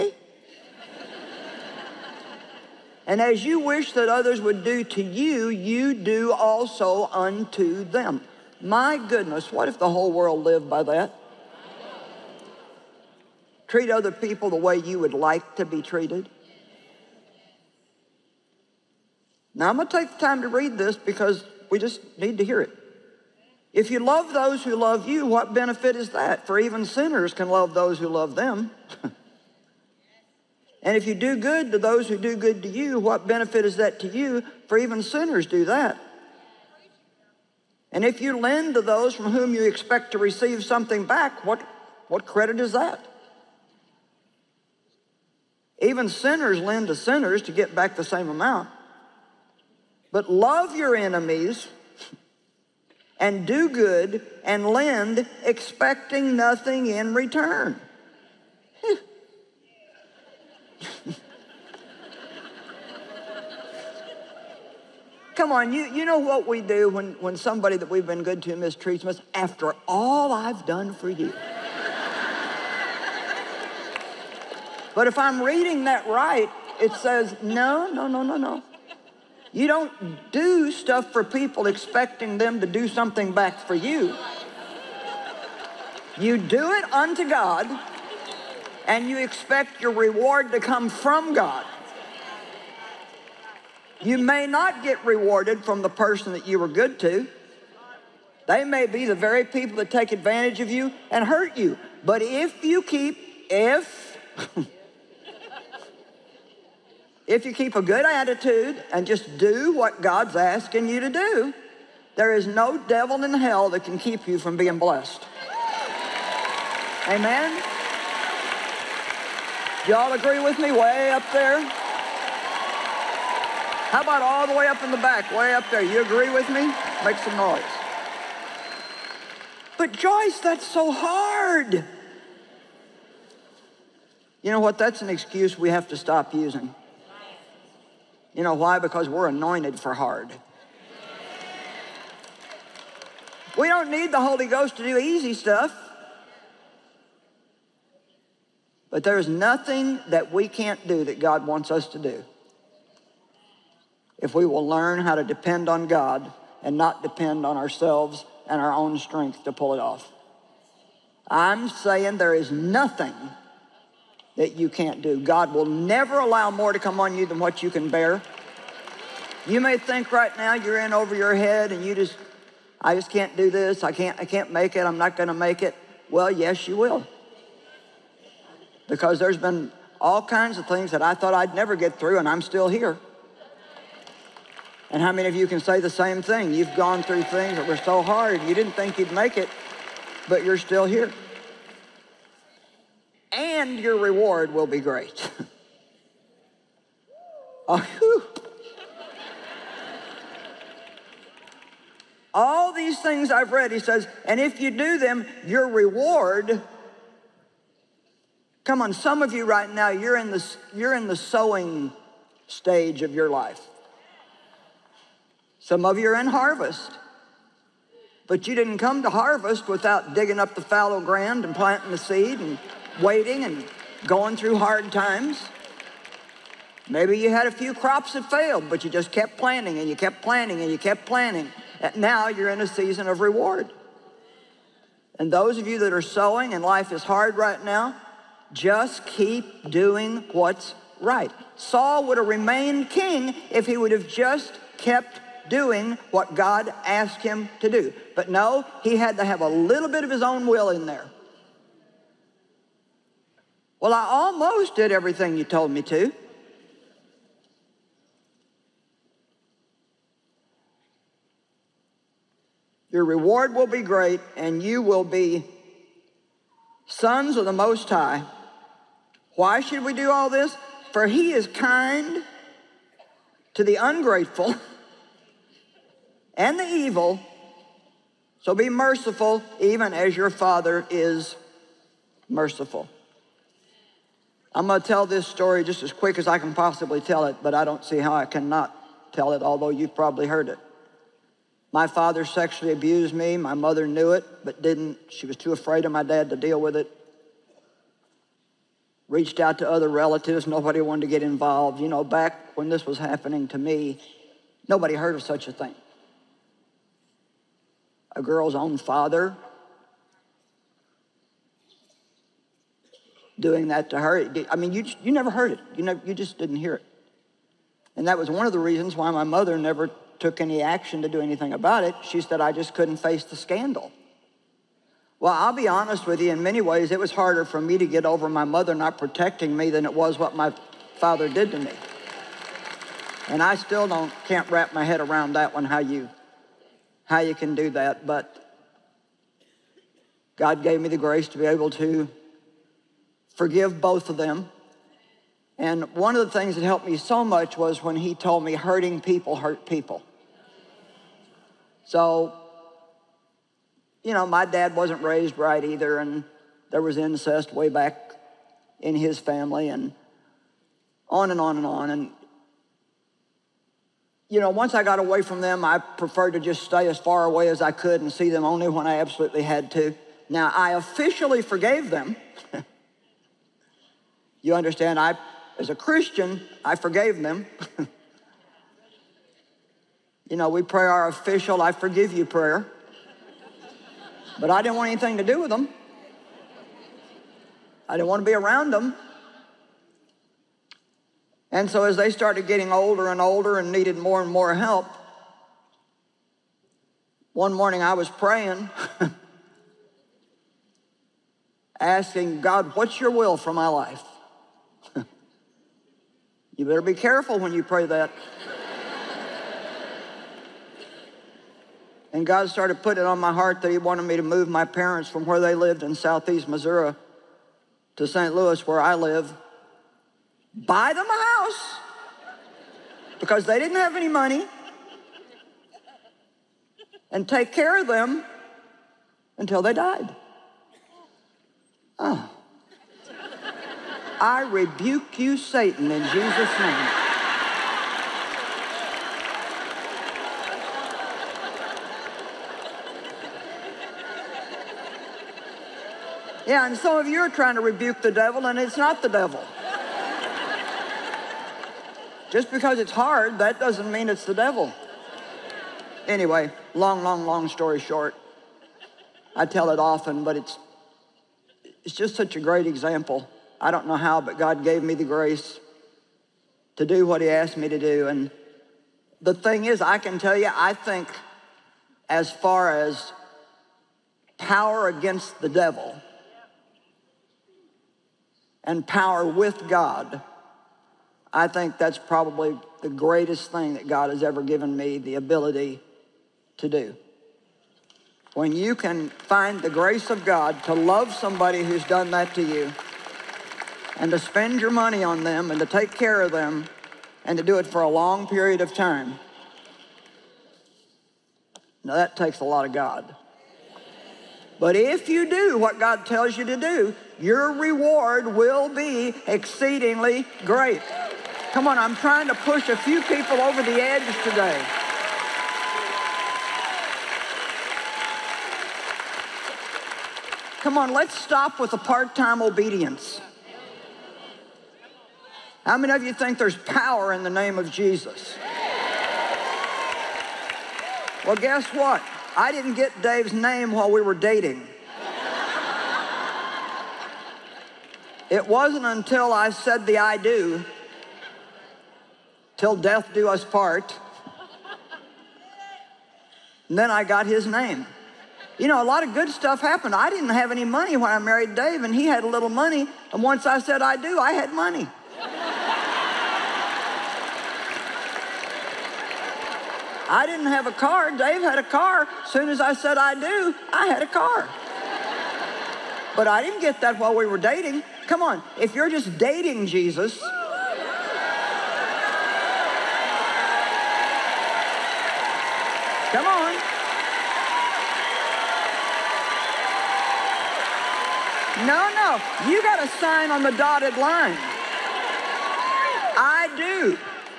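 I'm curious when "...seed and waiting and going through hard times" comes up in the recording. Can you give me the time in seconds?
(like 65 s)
221 s.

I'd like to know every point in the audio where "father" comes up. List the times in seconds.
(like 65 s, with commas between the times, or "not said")
280 s, 291 s, 308 s, 330 s.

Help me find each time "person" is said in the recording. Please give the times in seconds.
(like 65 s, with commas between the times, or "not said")
95 s.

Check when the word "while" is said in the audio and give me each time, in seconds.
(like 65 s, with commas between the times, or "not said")
533 s, 566 s.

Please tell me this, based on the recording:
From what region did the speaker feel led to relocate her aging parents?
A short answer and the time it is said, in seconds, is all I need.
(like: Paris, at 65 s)
southeast Missouri, at 415 s.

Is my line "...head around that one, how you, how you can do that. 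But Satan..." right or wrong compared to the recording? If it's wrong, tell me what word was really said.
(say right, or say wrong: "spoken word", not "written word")
wrong: "God", not "Satan".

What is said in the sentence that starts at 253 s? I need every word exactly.
Well, I almost did everything you told me to.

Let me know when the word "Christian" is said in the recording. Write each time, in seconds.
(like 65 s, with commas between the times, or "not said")
375 s.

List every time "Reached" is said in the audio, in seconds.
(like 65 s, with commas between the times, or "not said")
299 s.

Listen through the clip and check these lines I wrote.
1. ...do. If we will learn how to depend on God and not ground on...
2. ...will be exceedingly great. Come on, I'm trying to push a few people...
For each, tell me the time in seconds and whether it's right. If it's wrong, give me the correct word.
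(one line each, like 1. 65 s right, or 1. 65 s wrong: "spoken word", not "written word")
1. 151 s wrong: "depend", not "ground"
2. 508 s right.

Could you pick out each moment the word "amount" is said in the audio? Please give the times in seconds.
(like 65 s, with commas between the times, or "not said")
48 s.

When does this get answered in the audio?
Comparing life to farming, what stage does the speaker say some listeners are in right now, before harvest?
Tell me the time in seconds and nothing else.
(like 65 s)
211 s.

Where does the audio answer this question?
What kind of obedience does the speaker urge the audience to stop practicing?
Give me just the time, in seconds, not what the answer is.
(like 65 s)
521 s.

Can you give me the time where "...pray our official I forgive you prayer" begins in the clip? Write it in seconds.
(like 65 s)
380 s.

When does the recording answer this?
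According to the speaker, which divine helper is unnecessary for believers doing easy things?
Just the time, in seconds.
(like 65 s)
144 s.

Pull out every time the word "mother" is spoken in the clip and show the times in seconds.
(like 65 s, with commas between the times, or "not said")
293 s, 319 s, 328 s.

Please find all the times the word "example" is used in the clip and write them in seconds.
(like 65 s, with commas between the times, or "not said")
462 s.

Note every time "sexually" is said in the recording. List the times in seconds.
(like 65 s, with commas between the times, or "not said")
292 s.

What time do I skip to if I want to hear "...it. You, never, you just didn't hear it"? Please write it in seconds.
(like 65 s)
315 s.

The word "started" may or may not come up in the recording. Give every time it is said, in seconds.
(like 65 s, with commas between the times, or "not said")
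392 s, 412 s.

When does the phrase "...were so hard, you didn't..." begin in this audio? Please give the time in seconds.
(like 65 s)
187 s.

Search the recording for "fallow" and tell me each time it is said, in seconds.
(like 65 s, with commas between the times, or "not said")
220 s.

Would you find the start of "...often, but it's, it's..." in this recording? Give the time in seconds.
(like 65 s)
459 s.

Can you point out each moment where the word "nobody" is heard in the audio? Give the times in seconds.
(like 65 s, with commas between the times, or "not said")
300 s, 304 s.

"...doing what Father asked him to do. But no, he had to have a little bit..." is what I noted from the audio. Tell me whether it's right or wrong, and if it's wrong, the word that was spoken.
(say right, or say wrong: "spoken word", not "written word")
wrong: "God", not "Father".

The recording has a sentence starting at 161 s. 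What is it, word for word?
I'm saying there is nothing that you can't do.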